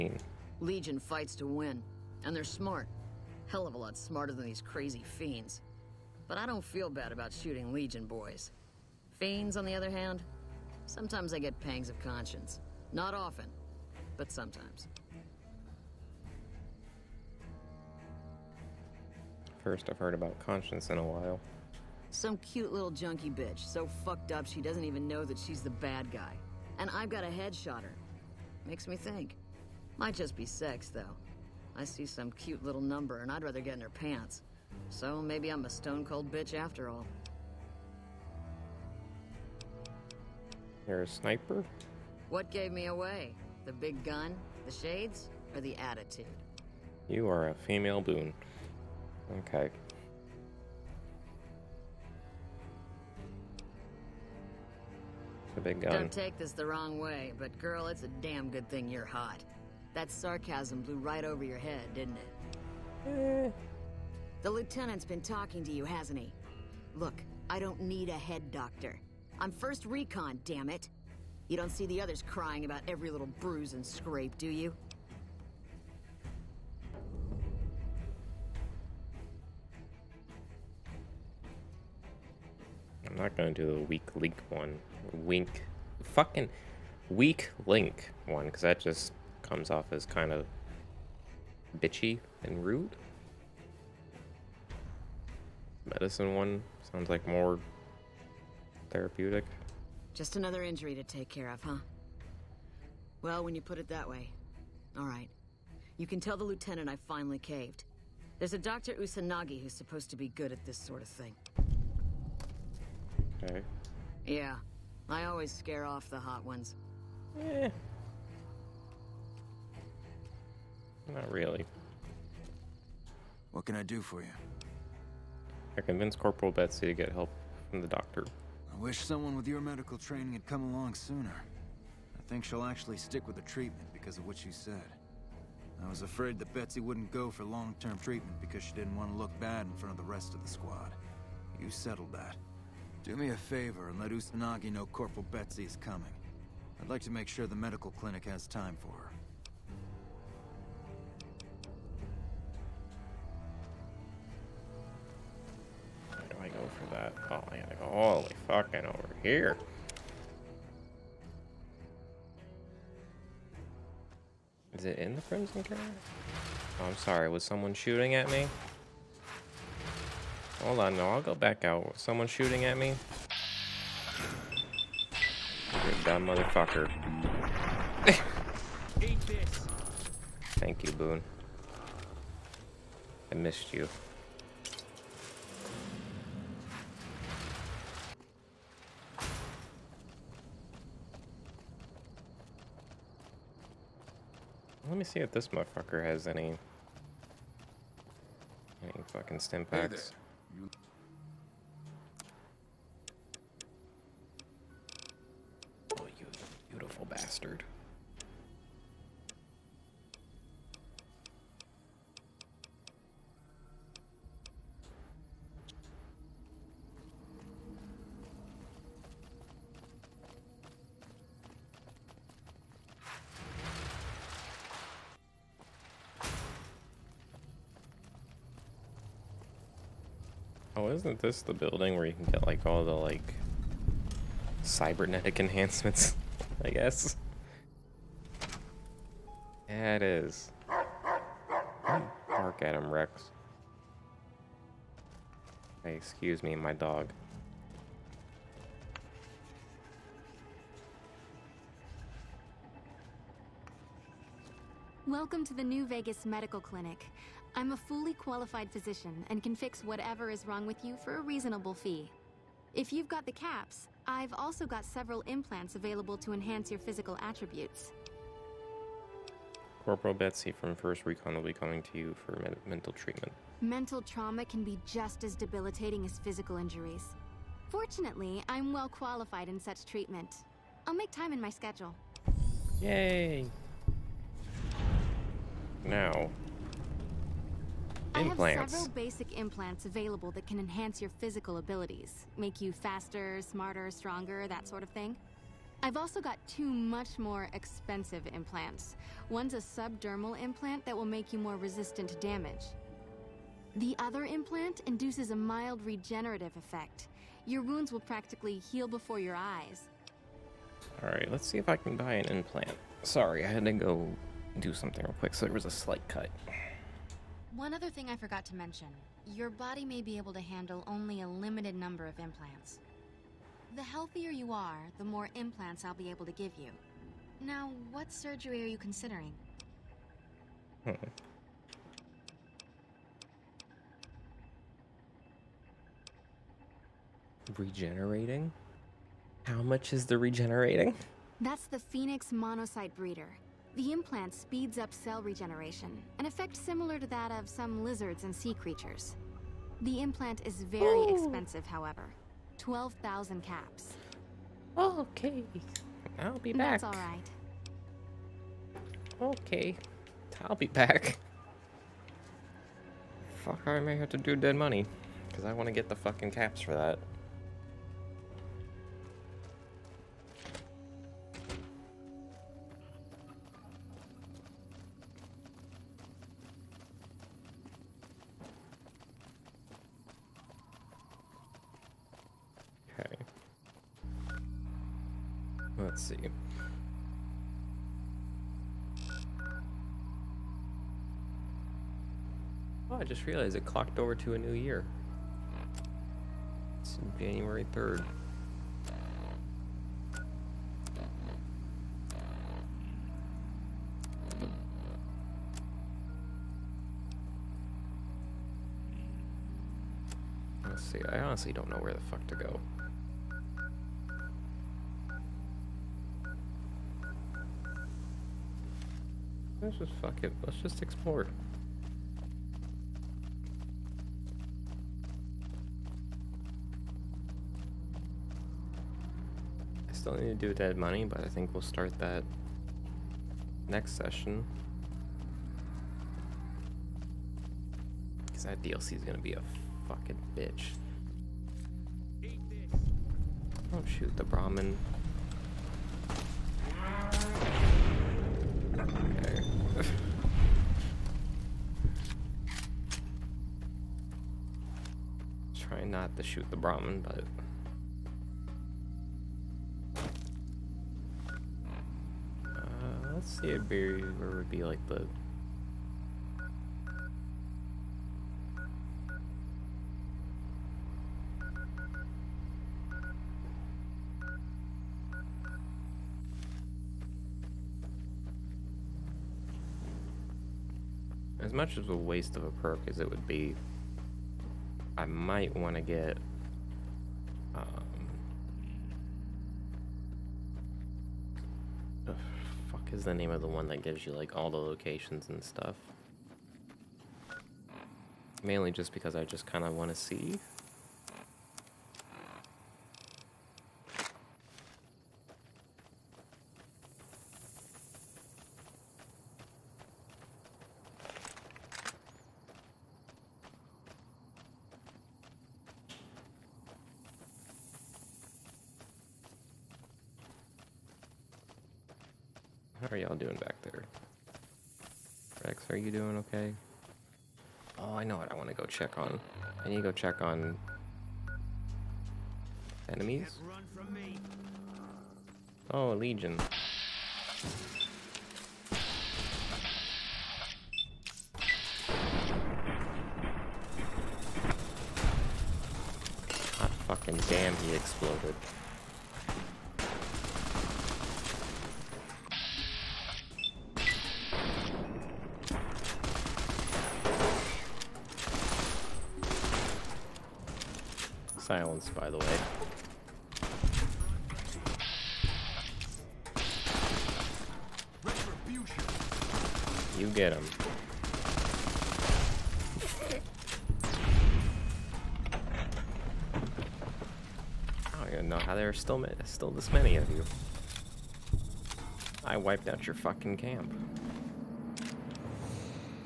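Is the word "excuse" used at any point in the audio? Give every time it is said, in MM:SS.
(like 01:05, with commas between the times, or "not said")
04:05.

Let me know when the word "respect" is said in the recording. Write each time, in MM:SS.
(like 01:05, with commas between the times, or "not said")
not said.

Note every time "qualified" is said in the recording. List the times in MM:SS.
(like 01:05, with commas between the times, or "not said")
04:18, 04:38.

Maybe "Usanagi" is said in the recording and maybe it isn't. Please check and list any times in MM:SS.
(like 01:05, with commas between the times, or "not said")
01:48, 02:24.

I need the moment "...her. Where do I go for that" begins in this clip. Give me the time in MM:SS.
02:36.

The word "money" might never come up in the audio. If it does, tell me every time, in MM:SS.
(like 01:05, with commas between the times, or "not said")
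06:04, 07:10.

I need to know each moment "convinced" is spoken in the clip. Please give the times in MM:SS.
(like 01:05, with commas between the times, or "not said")
02:05.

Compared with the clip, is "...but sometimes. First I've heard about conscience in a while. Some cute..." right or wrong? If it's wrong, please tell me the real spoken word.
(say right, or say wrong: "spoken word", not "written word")
right.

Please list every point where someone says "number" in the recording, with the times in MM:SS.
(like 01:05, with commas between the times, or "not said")
00:32, 05:21.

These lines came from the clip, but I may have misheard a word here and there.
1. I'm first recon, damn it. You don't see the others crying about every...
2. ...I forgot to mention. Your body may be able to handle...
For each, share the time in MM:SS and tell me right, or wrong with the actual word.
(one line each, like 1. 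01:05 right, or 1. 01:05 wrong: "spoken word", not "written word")
1. 01:09 right
2. 05:18 right.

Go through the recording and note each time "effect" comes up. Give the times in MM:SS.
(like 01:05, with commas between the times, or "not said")
05:06, 05:46.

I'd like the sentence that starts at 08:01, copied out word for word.
As much of a waste of a perk as it would be I might want to get...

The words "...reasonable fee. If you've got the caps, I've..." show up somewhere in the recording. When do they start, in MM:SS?
04:21.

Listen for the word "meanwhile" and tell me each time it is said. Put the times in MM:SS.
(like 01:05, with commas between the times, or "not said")
not said.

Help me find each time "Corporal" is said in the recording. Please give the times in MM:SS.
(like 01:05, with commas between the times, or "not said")
02:06, 02:24, 04:29.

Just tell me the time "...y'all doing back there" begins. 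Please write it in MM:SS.
08:42.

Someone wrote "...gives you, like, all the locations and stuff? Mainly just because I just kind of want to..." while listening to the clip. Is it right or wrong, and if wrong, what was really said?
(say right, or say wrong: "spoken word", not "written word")
right.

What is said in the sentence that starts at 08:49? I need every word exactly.
I need to go check on enemies.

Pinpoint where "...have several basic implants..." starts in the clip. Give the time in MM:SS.
04:48.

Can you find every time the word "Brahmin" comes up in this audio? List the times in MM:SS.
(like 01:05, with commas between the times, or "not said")
07:24, 07:36.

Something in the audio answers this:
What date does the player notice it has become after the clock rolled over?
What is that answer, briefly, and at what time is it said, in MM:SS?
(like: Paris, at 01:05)
January 3rd, at 06:37.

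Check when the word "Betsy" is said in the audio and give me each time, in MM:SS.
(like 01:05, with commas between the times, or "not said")
02:06, 02:16, 02:25, 04:30.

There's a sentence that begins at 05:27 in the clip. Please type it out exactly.
Now, what surgery are you considering?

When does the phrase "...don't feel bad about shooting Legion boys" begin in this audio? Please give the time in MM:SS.
00:06.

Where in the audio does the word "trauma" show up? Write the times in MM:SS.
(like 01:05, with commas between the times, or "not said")
04:34.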